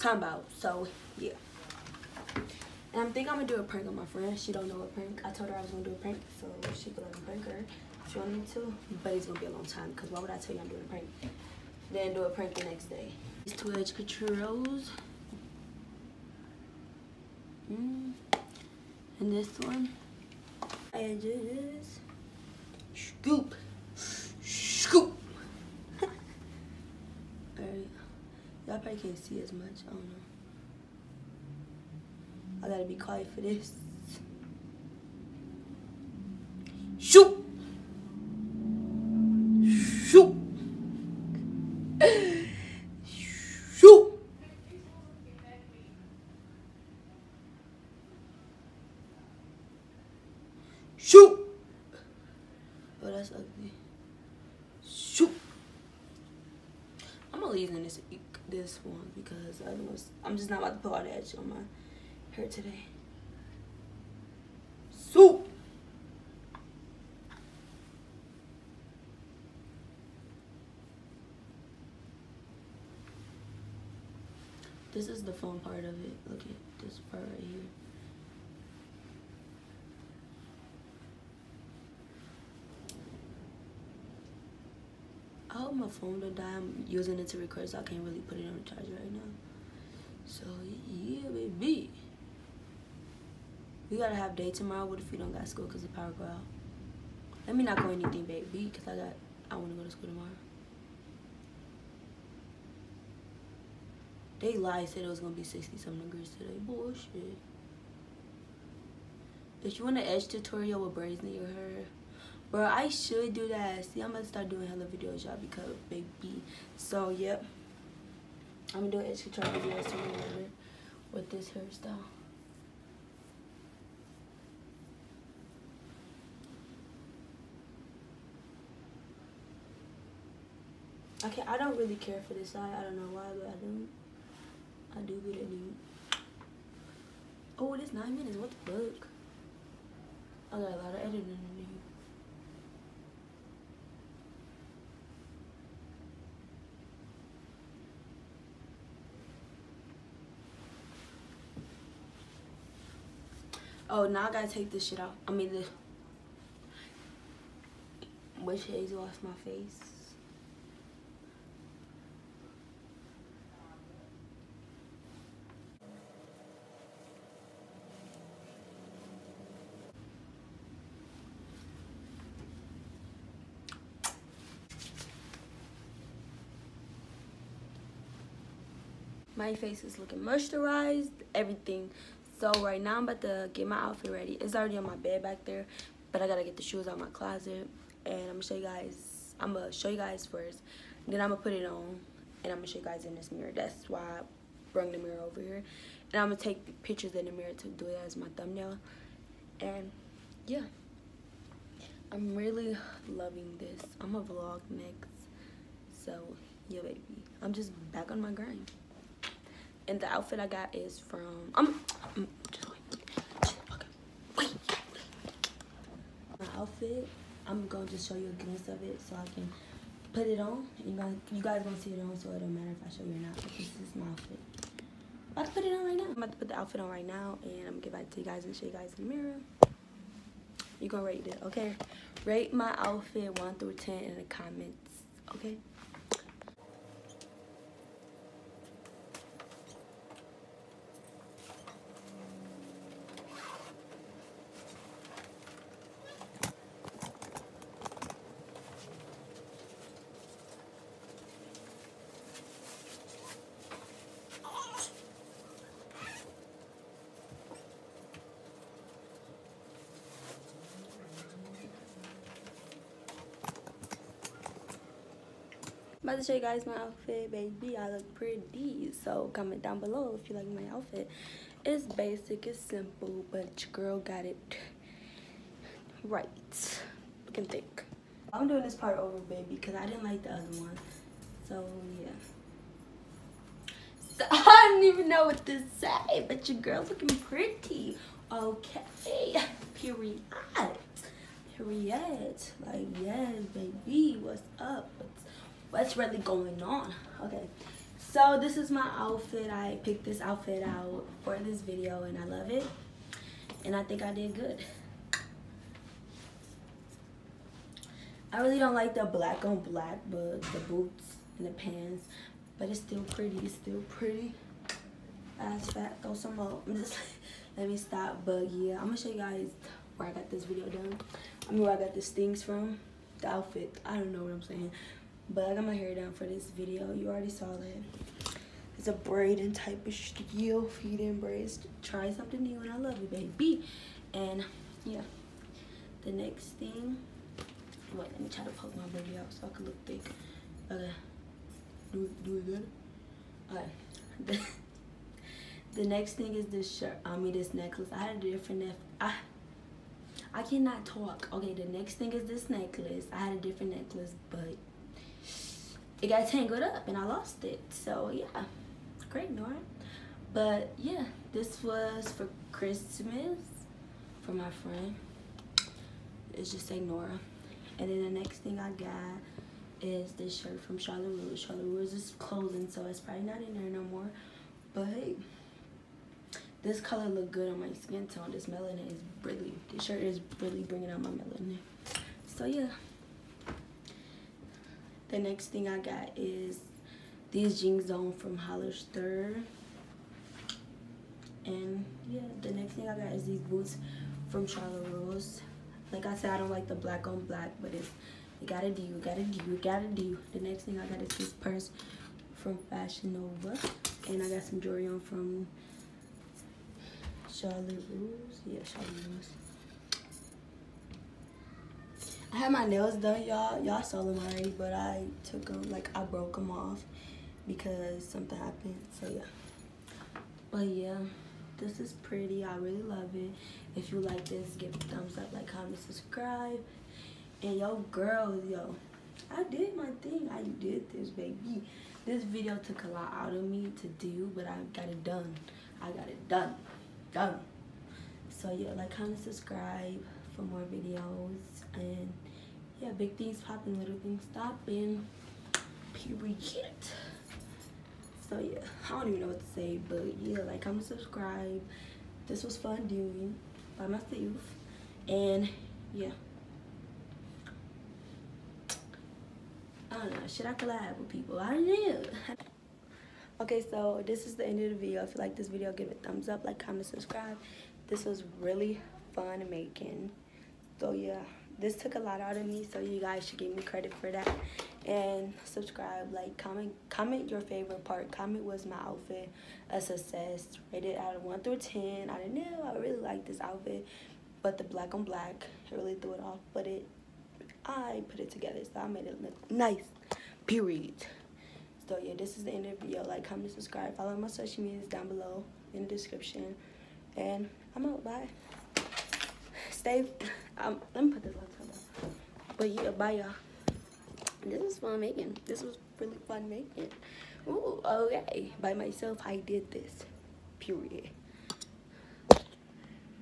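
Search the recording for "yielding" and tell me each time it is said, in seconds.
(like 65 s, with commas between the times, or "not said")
not said.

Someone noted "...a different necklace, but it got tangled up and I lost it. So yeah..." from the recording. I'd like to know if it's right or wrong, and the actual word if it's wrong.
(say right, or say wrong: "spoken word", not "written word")
right.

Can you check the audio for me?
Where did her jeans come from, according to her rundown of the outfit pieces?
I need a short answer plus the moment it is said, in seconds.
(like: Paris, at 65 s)
Hollister, at 388 s.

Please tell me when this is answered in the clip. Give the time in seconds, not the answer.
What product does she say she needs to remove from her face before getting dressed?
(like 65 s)
155 s.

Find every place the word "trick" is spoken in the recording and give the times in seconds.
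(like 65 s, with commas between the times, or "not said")
not said.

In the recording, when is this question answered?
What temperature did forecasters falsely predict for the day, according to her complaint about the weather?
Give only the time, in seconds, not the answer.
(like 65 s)
105 s.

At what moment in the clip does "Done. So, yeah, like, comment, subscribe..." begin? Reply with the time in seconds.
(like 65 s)
437 s.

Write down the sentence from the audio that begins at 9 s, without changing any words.
But it's gonna be a long time, because why would I tell you I'm doing a prank?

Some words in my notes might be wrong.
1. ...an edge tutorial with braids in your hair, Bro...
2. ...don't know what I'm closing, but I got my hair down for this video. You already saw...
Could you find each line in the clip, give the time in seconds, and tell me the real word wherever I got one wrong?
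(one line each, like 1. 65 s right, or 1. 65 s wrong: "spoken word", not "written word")
1. 109 s right
2. 323 s wrong: "saying", not "closing".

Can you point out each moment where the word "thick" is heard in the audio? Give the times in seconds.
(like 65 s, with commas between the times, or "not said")
277 s, 339 s.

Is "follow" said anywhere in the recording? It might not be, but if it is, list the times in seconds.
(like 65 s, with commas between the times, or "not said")
493 s.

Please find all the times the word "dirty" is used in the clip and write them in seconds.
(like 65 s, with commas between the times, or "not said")
not said.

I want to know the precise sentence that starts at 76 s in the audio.
Look at this part right here.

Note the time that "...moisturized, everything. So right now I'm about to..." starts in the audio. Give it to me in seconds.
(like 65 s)
180 s.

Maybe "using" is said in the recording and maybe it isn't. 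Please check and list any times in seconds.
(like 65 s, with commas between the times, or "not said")
57 s, 86 s.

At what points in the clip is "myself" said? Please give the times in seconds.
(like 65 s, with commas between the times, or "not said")
453 s, 508 s.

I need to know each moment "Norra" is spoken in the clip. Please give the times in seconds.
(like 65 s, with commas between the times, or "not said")
359 s, 366 s.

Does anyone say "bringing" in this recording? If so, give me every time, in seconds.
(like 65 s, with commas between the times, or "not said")
380 s.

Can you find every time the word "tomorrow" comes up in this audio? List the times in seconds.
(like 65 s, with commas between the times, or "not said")
94 s, 100 s.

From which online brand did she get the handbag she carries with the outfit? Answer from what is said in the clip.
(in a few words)
Fashion Nova.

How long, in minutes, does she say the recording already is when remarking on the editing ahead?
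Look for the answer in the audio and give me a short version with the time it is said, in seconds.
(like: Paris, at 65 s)
9, at 137 s.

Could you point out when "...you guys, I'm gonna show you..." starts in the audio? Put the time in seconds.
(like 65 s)
188 s.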